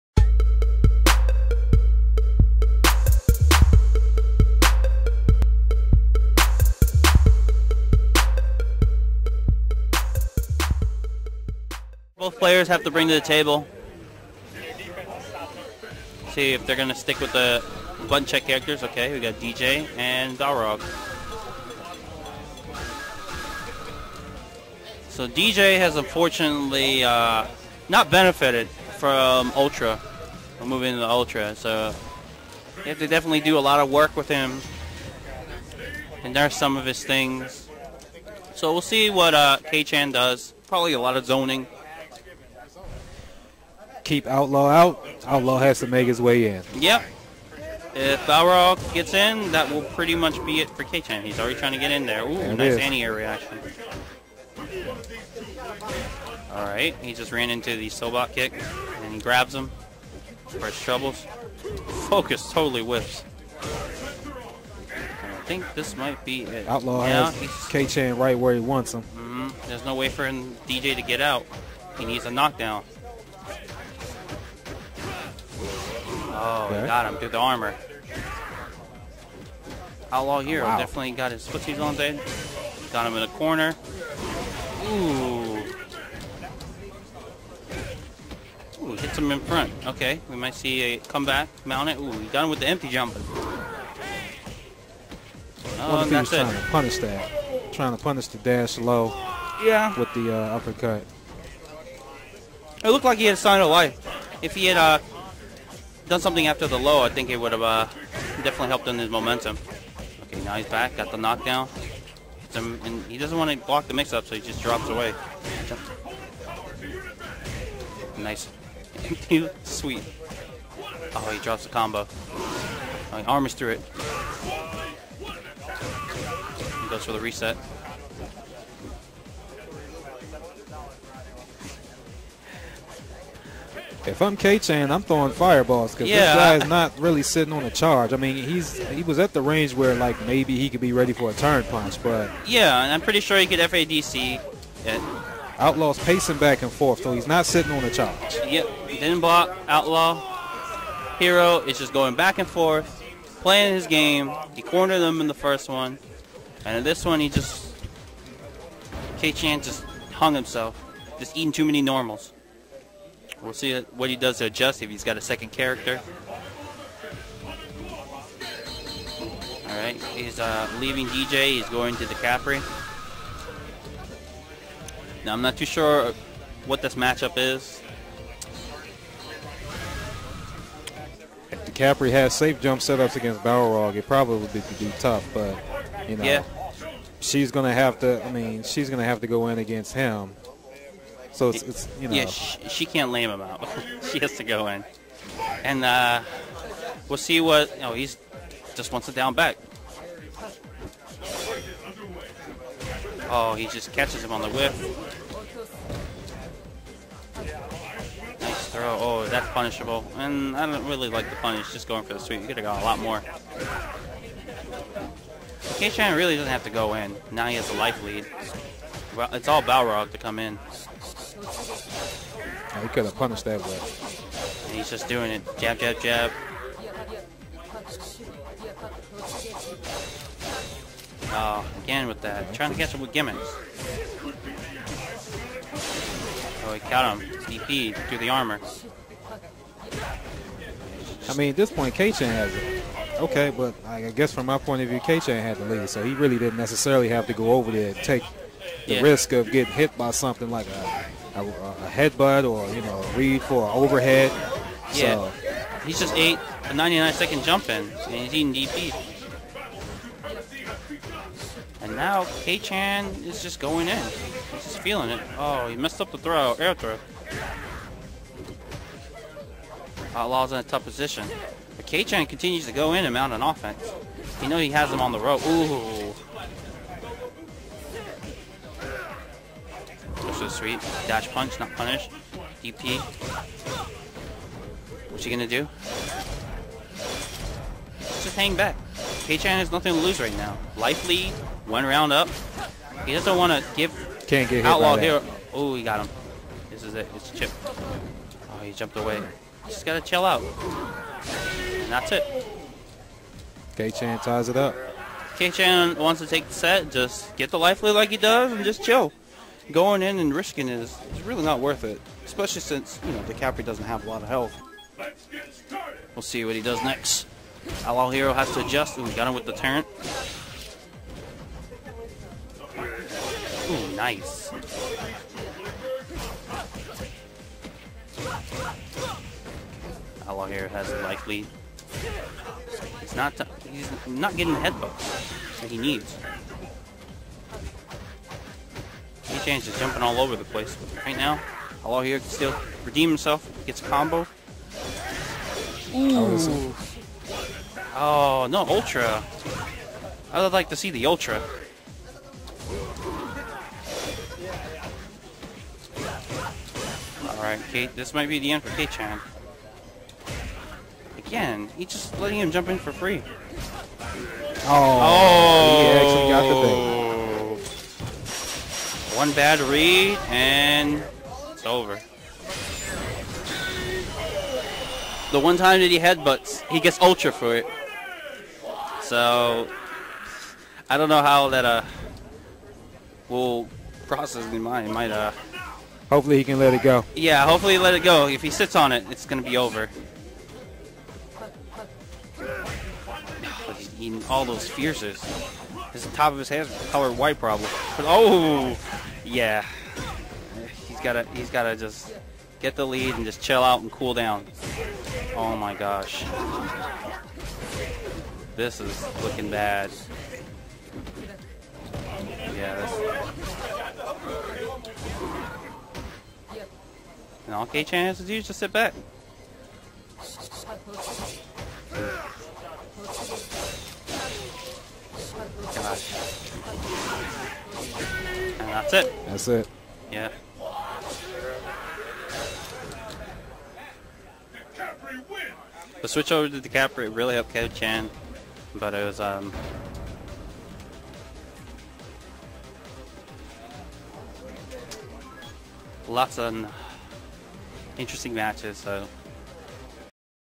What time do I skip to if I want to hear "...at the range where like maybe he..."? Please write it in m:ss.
2:19.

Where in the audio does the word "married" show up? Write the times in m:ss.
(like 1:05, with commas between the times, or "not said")
not said.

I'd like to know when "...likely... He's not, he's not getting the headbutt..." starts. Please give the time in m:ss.
5:31.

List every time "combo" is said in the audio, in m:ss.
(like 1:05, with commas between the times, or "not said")
2:01, 5:43.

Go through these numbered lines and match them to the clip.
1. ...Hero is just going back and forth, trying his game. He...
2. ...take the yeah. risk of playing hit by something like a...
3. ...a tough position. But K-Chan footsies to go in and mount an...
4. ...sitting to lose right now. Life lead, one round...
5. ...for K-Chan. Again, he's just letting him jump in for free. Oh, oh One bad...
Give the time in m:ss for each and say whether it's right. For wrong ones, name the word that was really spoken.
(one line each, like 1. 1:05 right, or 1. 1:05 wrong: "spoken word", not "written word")
1. 2:31 wrong: "playing", not "trying"
2. 4:07 wrong: "getting", not "playing"
3. 4:30 wrong: "continues", not "footsies"
4. 4:49 wrong: "nothing", not "sitting"
5. 5:58 right.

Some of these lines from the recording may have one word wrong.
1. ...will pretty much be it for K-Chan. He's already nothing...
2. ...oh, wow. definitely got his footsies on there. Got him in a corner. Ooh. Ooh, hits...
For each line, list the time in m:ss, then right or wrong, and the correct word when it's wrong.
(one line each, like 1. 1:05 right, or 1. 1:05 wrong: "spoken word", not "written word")
1. 0:49 wrong: "trying", not "nothing"
2. 1:20 right.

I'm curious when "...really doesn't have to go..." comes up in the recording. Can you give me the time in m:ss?
3:36.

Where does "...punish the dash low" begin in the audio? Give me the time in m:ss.
1:38.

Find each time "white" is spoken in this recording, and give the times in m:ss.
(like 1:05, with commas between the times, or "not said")
6:37.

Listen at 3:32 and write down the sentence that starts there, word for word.
You could have got a lot more.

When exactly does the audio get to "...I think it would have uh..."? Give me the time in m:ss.
1:47.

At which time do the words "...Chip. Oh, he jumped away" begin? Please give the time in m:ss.
4:57.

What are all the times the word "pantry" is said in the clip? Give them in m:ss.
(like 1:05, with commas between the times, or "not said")
not said.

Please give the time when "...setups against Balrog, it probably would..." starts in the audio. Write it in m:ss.
3:02.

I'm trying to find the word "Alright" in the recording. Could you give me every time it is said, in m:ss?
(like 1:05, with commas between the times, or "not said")
0:56, 5:57.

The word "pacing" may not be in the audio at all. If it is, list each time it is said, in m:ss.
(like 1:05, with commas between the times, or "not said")
2:26.